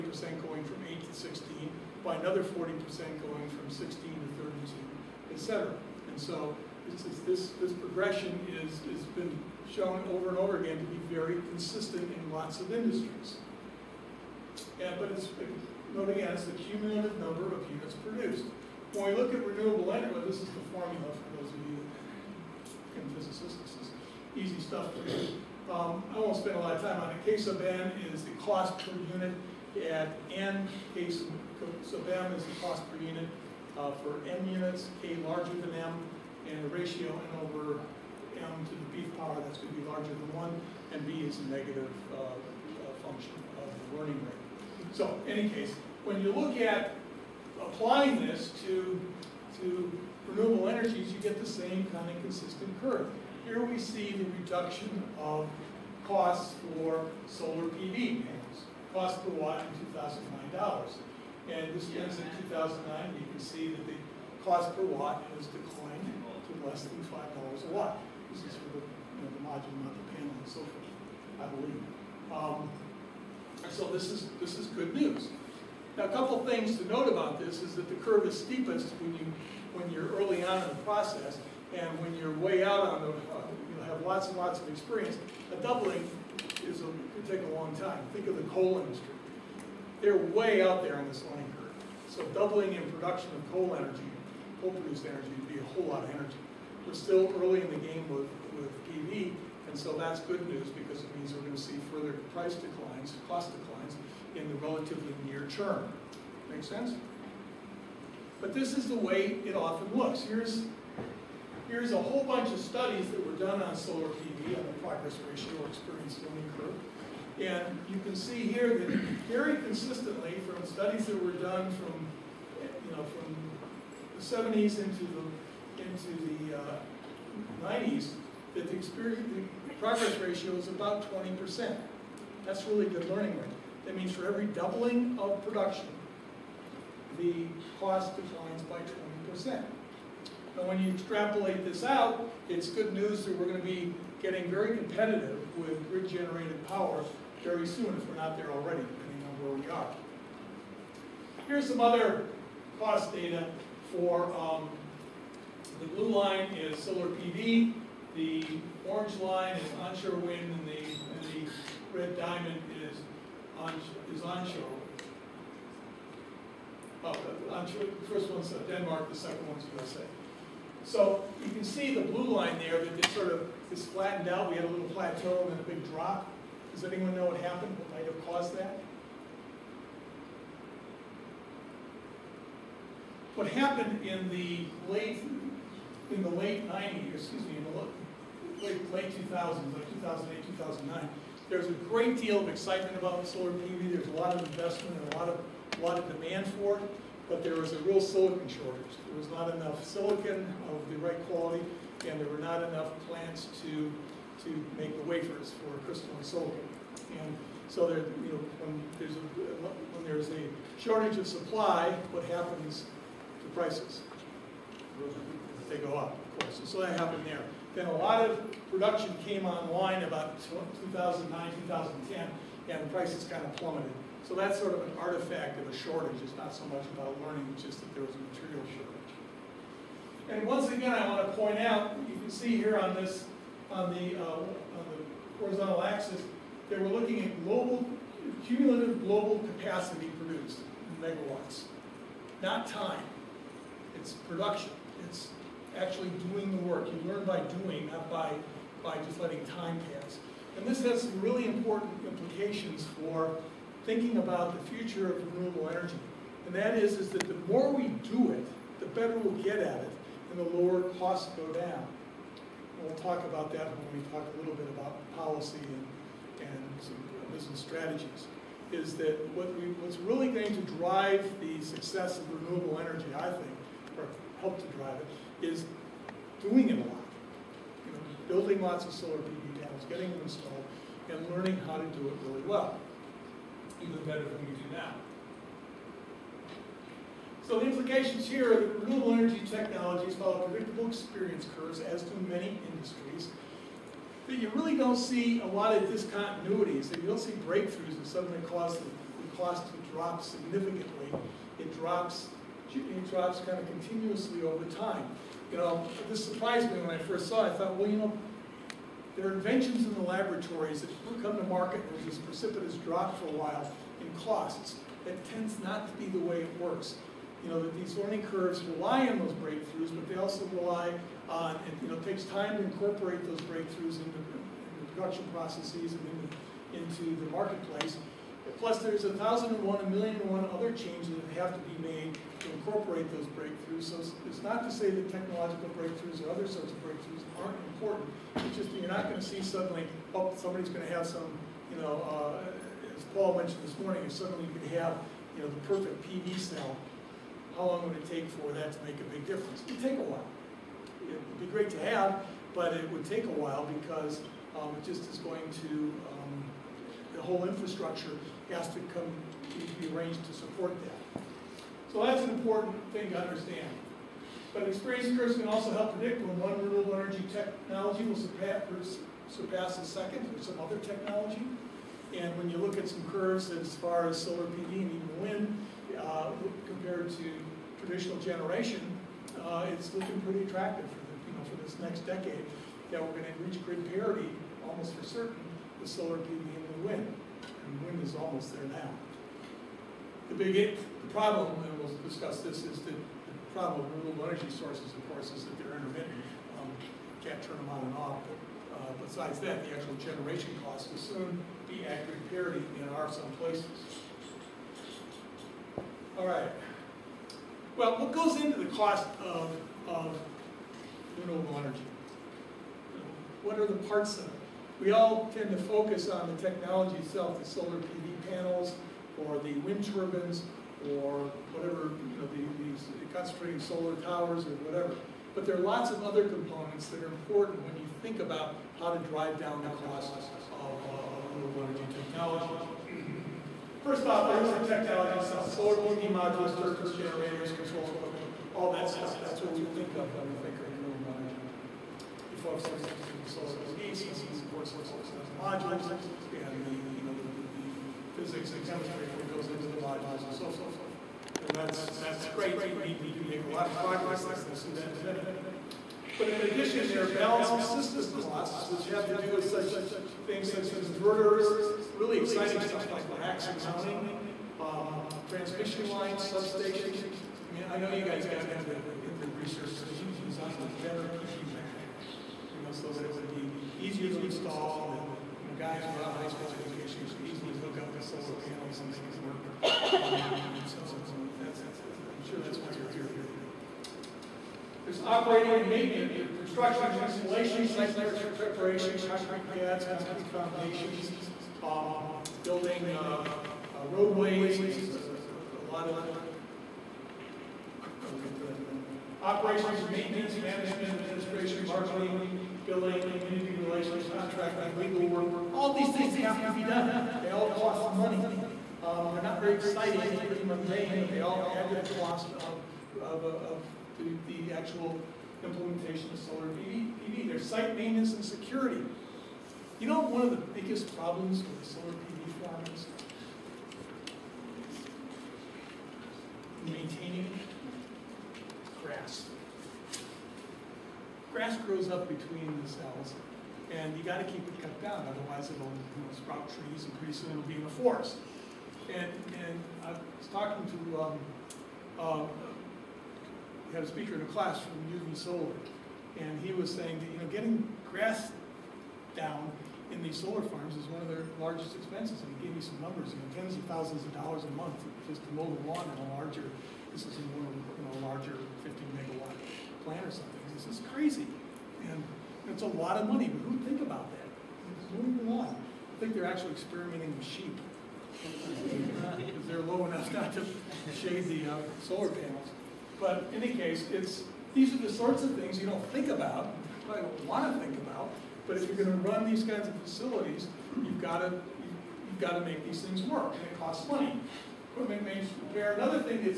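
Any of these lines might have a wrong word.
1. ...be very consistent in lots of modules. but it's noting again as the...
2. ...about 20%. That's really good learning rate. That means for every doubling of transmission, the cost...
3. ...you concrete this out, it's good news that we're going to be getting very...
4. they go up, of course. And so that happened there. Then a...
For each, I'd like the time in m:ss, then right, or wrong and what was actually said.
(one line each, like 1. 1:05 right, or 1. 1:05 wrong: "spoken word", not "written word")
1. 0:10 wrong: "industries", not "modules"
2. 2:10 wrong: "production", not "transmission"
3. 2:20 wrong: "extrapolate", not "concrete"
4. 3:35 right.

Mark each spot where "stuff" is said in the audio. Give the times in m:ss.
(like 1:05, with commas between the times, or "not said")
0:24, 7:18, 7:42.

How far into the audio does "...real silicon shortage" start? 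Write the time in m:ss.
3:17.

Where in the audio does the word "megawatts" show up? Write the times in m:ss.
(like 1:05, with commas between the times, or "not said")
4:01, 9:18.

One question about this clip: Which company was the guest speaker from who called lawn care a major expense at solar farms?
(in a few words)
UV Solar.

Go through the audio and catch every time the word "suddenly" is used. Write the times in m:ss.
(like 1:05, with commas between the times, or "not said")
4:58, 5:39, 5:44.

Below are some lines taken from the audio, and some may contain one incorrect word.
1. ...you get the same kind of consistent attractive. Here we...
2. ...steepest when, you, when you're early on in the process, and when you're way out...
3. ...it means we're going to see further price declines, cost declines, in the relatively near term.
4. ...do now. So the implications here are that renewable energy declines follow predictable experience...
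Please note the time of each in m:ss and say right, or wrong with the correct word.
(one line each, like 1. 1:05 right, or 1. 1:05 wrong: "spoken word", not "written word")
1. 0:51 wrong: "curve", not "attractive"
2. 1:18 right
3. 1:41 right
4. 4:44 wrong: "technologies", not "declines".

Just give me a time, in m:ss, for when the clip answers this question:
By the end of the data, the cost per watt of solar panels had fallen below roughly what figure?
1:07.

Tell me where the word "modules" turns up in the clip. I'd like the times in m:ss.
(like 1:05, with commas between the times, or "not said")
1:09, 7:16, 7:25, 7:29.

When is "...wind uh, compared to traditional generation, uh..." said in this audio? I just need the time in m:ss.
6:15.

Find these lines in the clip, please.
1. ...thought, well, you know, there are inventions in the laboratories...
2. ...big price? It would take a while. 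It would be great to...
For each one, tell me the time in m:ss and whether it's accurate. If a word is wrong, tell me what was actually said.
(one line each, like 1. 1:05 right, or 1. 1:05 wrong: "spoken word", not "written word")
1. 5:07 right
2. 5:49 wrong: "difference", not "price".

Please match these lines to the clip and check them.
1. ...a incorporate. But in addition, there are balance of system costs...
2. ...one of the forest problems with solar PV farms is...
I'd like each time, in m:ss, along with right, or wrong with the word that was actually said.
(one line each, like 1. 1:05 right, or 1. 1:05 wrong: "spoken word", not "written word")
1. 7:35 wrong: "minute", not "incorporate"
2. 8:40 wrong: "biggest", not "forest".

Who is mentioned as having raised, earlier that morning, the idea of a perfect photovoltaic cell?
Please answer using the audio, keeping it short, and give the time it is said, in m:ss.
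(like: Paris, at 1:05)
Paul, at 5:43.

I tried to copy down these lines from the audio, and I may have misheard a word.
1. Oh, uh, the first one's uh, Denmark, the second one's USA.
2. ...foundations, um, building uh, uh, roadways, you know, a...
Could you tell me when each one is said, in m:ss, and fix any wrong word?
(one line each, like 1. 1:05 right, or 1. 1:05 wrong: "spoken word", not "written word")
1. 2:47 right
2. 8:10 right.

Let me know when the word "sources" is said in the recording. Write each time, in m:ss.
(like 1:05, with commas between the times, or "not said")
6:34.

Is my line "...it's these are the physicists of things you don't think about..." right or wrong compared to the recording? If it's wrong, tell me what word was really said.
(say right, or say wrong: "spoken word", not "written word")
wrong: "sorts", not "physicists".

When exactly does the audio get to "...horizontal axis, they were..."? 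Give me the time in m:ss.
3:55.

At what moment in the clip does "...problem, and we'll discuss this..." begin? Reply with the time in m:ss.
6:31.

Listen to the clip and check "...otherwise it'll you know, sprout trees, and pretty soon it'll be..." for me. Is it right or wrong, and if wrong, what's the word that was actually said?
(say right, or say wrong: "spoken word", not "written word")
right.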